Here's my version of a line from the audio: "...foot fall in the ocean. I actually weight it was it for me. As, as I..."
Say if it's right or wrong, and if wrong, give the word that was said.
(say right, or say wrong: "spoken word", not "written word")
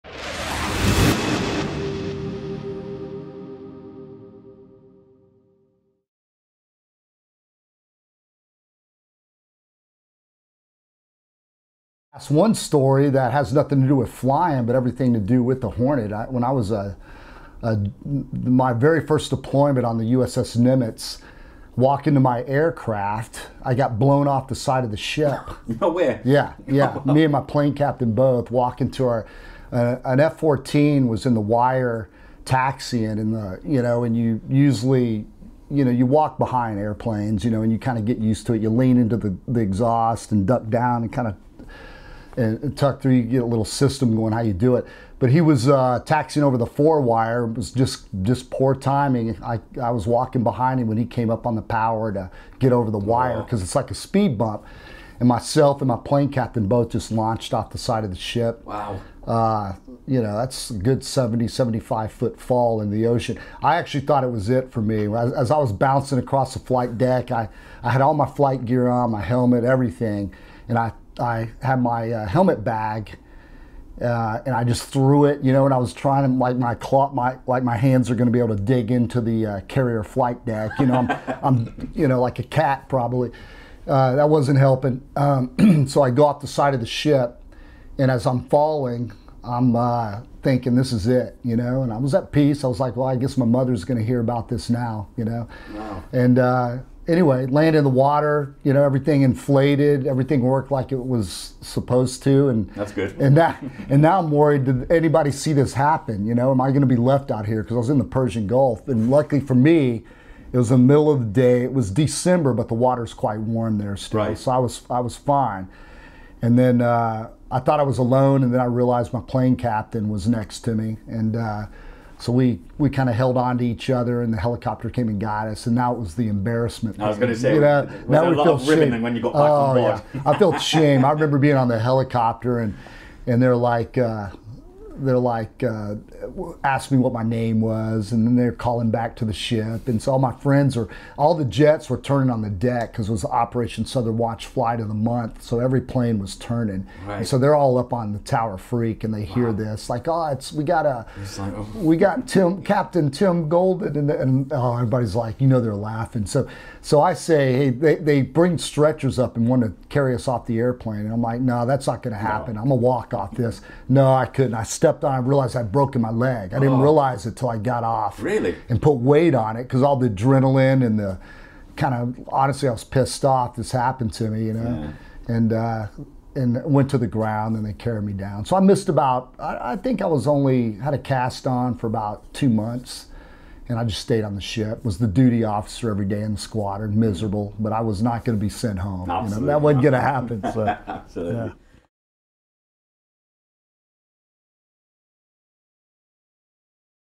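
wrong: "thought", not "weight".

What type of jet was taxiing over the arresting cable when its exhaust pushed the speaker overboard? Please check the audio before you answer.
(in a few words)
F-14.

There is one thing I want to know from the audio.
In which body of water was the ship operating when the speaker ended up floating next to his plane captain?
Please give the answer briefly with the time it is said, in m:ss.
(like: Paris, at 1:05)
Persian Gulf, at 1:48.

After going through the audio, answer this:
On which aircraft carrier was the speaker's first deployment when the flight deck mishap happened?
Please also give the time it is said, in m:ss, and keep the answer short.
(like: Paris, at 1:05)
USS Nimitz, at 0:20.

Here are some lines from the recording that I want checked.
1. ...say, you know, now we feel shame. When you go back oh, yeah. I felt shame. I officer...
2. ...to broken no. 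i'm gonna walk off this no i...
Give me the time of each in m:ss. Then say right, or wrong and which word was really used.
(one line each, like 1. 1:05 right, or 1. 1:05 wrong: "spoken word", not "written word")
1. 2:07 wrong: "remember", not "officer"
2. 2:42 wrong: "happen", not "broken".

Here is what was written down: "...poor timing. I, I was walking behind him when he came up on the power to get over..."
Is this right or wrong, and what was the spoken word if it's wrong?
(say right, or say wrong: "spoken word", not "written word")
right.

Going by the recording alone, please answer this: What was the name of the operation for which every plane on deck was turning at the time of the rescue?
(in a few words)
Operation Southern Watch.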